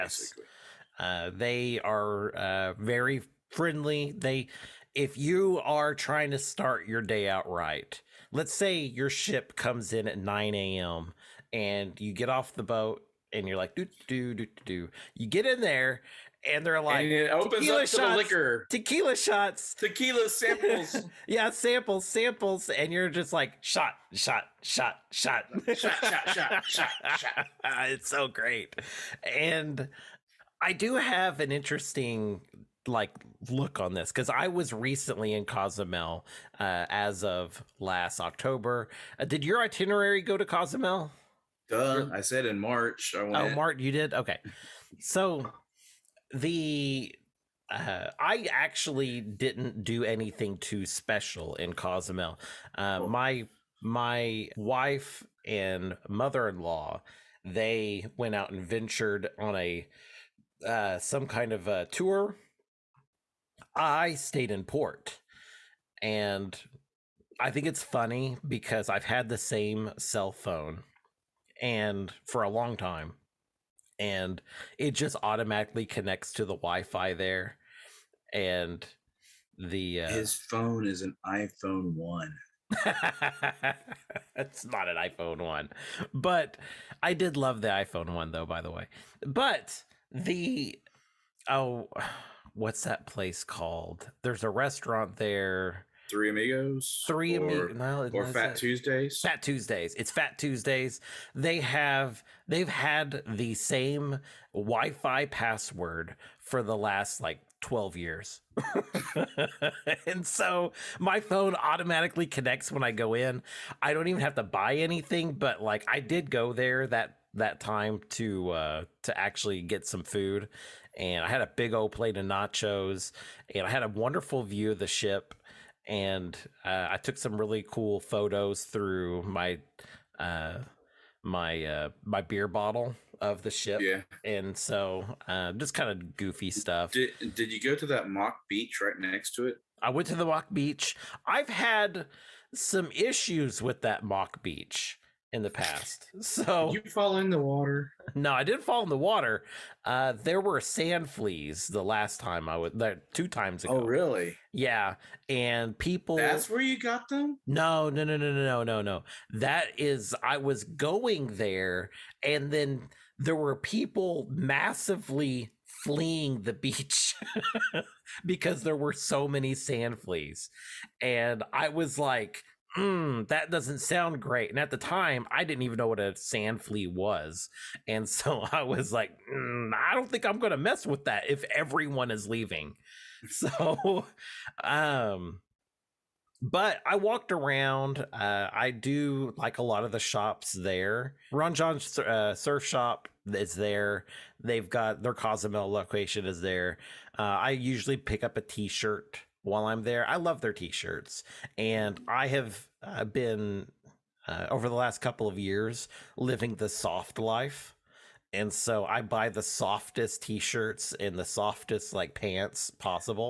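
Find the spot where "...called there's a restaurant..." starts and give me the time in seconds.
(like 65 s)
93 s.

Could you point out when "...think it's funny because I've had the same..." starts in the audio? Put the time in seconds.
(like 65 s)
67 s.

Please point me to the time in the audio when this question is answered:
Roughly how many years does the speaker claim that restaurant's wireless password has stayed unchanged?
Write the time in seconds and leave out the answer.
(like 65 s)
107 s.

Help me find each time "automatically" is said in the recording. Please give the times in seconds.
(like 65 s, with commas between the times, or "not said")
75 s, 111 s.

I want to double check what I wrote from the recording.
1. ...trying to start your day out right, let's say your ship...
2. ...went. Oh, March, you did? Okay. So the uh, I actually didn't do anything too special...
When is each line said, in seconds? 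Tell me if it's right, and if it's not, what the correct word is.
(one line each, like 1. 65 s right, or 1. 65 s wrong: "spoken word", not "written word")
1. 5 s right
2. 43 s right.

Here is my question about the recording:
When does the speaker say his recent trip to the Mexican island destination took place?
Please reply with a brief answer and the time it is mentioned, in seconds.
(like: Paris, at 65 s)
last October, at 37 s.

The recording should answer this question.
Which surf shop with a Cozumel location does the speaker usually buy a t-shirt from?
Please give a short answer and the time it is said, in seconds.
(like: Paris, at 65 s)
Ron Jon's, at 191 s.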